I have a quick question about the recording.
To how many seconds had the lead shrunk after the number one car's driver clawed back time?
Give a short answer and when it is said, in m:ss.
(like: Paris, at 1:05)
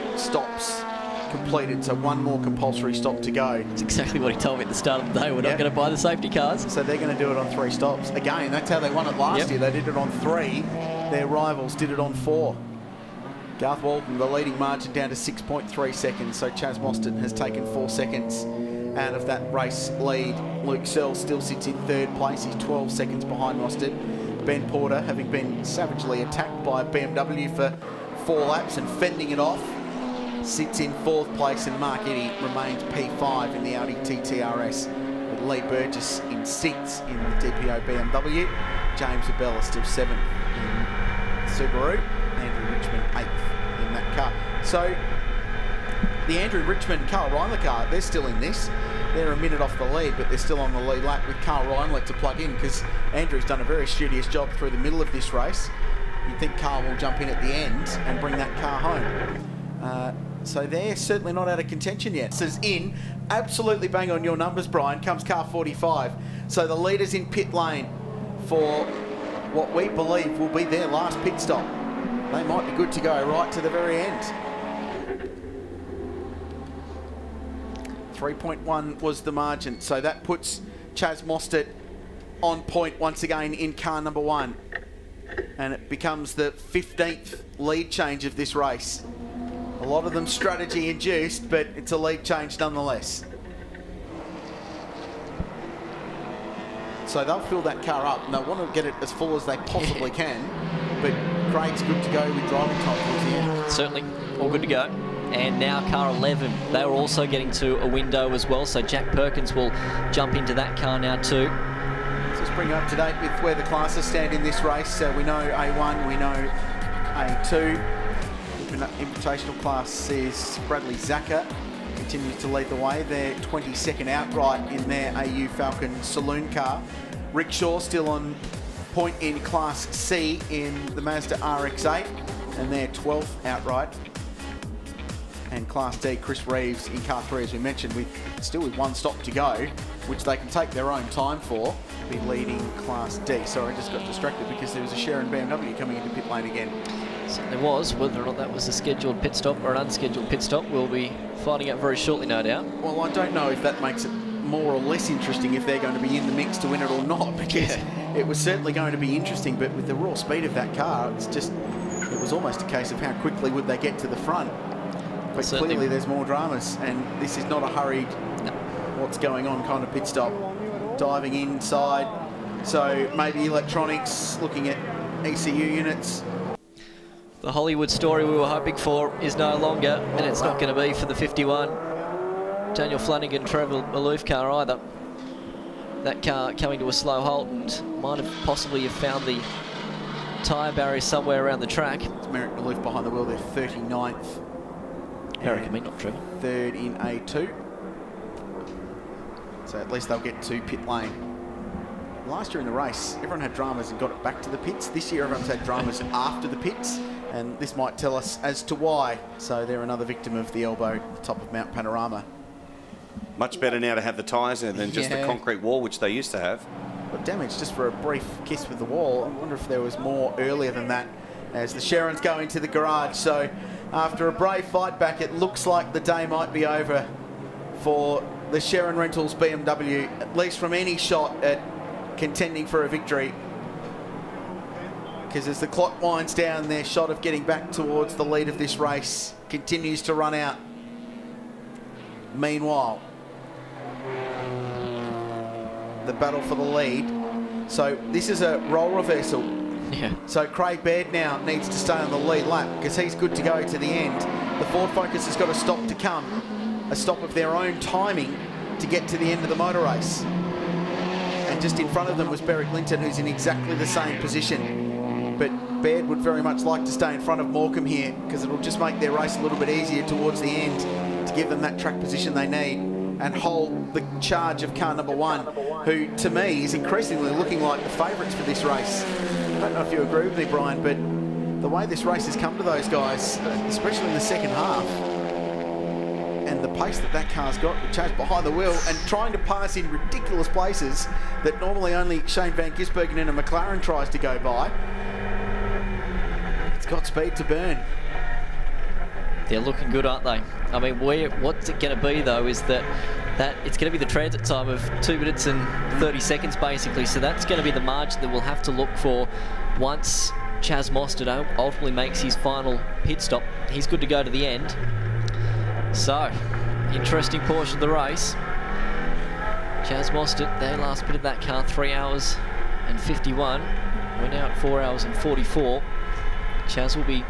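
6.3 seconds, at 0:15.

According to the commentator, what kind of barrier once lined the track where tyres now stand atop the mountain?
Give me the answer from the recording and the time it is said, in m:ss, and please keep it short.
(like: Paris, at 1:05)
concrete wall, at 3:35.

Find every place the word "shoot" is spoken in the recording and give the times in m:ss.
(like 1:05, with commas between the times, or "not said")
not said.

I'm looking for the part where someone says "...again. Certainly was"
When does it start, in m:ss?
2:26.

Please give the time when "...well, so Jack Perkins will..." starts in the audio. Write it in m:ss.
1:48.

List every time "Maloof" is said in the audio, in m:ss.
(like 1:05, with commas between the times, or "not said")
3:03, 3:12.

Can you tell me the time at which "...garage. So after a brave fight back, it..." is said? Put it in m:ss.
3:42.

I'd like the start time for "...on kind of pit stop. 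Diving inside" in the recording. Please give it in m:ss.
2:49.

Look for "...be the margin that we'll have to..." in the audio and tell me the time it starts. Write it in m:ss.
5:07.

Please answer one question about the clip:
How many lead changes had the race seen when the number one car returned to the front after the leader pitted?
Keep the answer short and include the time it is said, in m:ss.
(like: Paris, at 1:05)
15, at 1:26.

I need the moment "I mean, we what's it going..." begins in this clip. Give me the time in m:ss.
5:00.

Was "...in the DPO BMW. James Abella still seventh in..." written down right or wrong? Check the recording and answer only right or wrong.
right.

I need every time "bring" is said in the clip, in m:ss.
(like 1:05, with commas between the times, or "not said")
0:58, 1:52.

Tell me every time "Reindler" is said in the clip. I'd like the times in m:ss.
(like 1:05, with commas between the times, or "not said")
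0:47, 0:51.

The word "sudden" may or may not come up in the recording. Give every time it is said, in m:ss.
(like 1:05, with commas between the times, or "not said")
not said.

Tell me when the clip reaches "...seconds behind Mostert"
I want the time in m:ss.
0:22.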